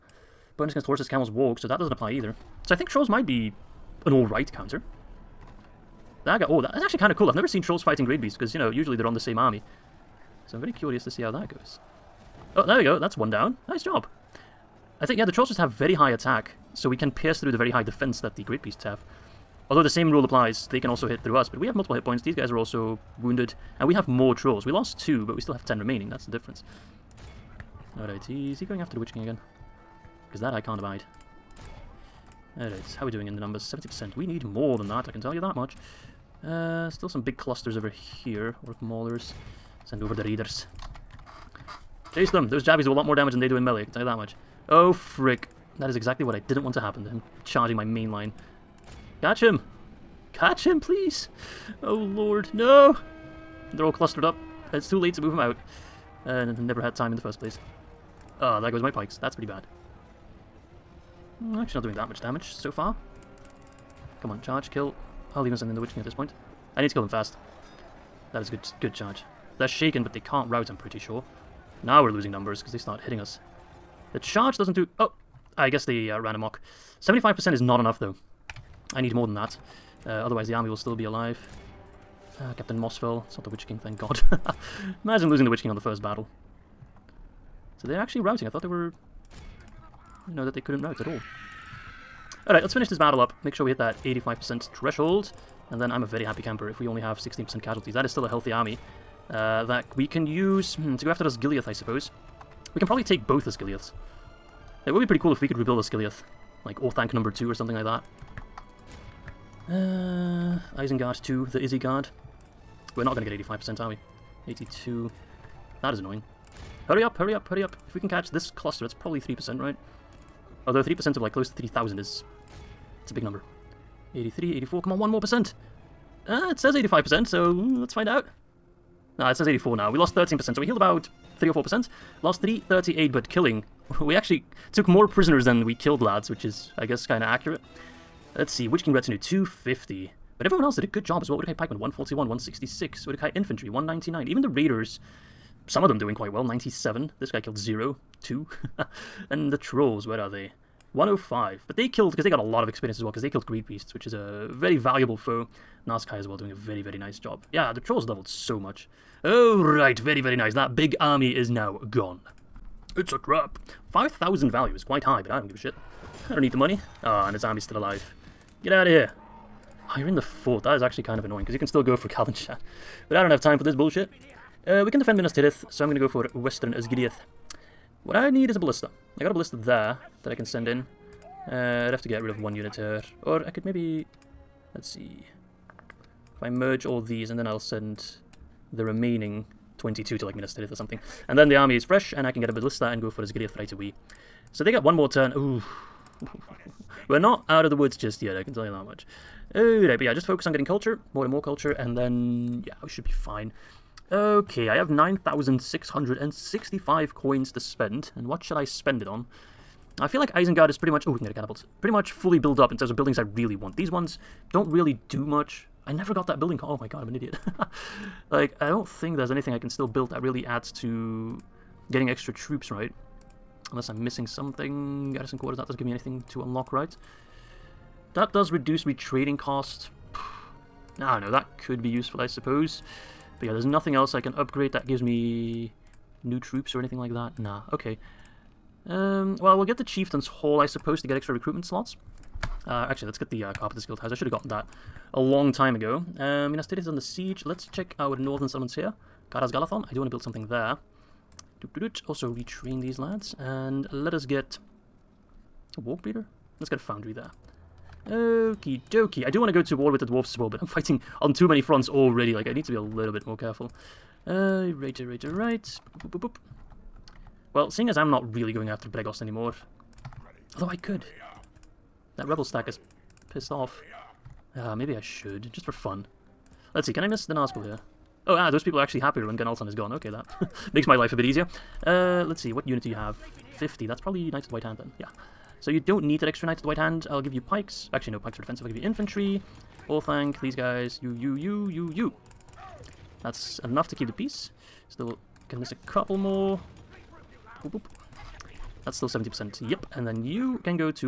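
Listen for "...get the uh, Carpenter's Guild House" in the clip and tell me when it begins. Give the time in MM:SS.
04:03.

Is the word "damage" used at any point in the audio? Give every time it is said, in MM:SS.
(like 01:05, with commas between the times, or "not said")
00:43, 01:02.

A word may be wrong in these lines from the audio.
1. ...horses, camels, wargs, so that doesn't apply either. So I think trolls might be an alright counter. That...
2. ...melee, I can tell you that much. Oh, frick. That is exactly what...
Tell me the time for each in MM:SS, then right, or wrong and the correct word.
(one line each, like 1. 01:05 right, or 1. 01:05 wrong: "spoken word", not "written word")
1. 00:00 right
2. 00:43 right.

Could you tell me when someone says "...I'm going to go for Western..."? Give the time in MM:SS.
02:55.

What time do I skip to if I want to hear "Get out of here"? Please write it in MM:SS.
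02:48.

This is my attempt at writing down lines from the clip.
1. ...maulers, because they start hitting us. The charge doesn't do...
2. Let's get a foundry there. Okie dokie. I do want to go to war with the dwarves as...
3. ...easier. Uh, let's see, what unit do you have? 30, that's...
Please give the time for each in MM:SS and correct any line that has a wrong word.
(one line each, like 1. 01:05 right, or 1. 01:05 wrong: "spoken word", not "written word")
1. 01:12 wrong: "numbers", not "maulers"
2. 04:16 right
3. 04:41 wrong: "50", not "30".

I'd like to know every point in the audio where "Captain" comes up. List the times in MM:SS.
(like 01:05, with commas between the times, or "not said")
01:22.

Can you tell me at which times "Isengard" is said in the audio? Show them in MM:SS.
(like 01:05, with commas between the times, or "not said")
01:50, 03:30.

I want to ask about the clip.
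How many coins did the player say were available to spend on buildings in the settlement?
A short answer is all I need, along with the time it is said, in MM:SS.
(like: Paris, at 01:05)
9,665, at 03:24.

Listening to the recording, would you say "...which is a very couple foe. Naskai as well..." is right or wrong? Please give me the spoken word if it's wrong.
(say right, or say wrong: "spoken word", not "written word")
wrong: "valuable", not "couple".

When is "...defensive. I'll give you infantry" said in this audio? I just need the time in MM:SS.
04:48.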